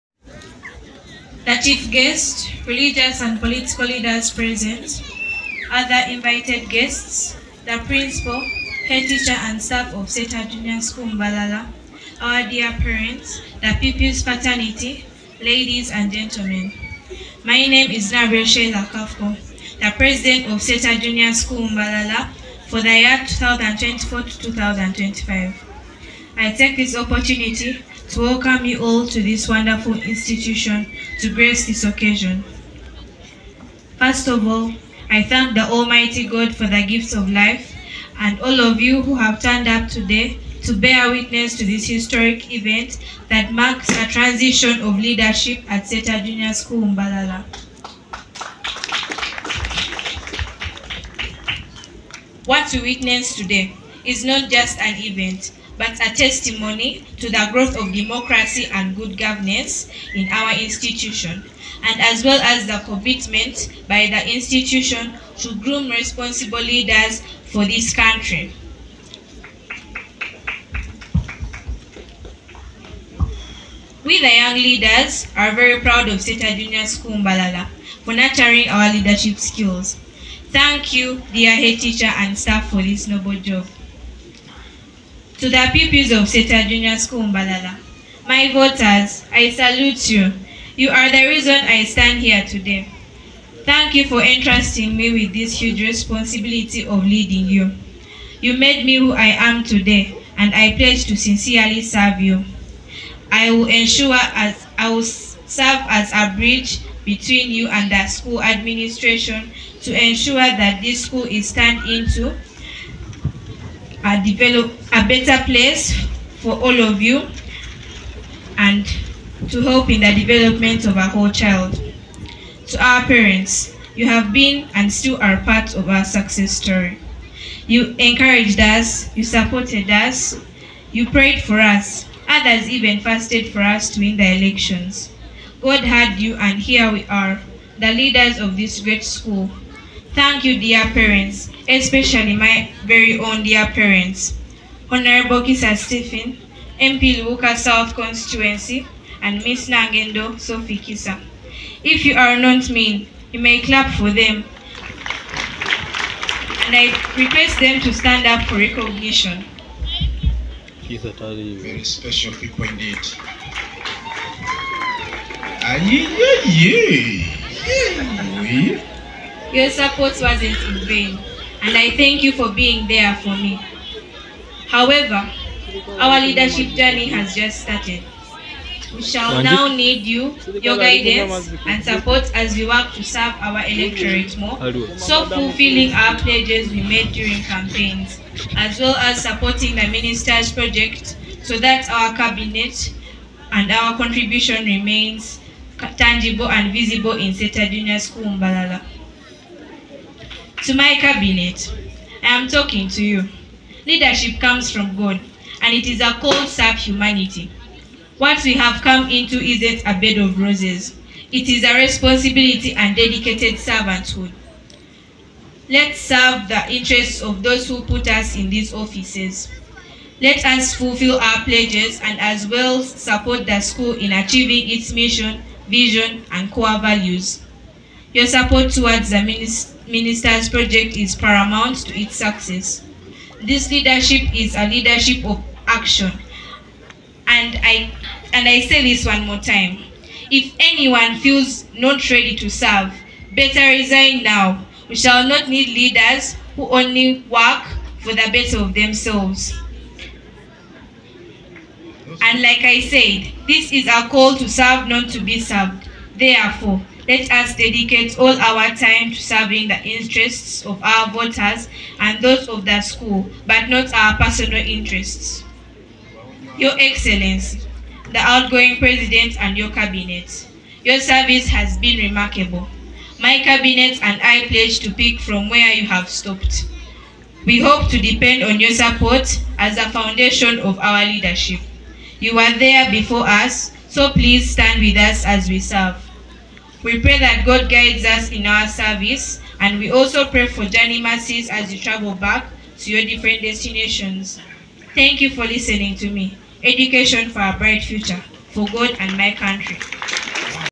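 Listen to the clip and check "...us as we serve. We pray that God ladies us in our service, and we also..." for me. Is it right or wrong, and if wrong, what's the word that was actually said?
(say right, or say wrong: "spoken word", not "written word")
wrong: "guides", not "ladies".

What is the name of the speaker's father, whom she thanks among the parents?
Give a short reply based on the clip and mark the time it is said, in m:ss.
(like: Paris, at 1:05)
Kisa Stephen, at 2:25.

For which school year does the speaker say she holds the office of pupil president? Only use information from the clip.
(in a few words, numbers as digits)
2024-2025.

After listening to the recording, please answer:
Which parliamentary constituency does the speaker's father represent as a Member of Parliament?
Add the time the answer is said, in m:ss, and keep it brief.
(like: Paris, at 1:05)
Luuka South, at 2:27.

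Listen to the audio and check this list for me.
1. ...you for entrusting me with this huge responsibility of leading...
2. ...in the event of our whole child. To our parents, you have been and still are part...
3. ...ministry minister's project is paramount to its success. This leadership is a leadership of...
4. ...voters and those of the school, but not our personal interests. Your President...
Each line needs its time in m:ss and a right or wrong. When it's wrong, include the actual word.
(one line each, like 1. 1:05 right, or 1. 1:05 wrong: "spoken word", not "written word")
1. 1:33 right
2. 1:59 wrong: "development", not "event"
3. 3:49 right
4. 4:21 wrong: "Excellency", not "President".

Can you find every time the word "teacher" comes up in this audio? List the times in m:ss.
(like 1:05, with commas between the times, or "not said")
0:09, 1:21.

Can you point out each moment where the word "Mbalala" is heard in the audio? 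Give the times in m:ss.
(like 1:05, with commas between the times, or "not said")
0:11, 0:21, 0:46, 1:17, 1:27, 3:18.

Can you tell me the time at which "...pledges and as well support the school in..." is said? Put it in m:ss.
3:41.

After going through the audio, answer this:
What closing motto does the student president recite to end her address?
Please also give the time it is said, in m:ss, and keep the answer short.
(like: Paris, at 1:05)
Education for a bright future, at 4:56.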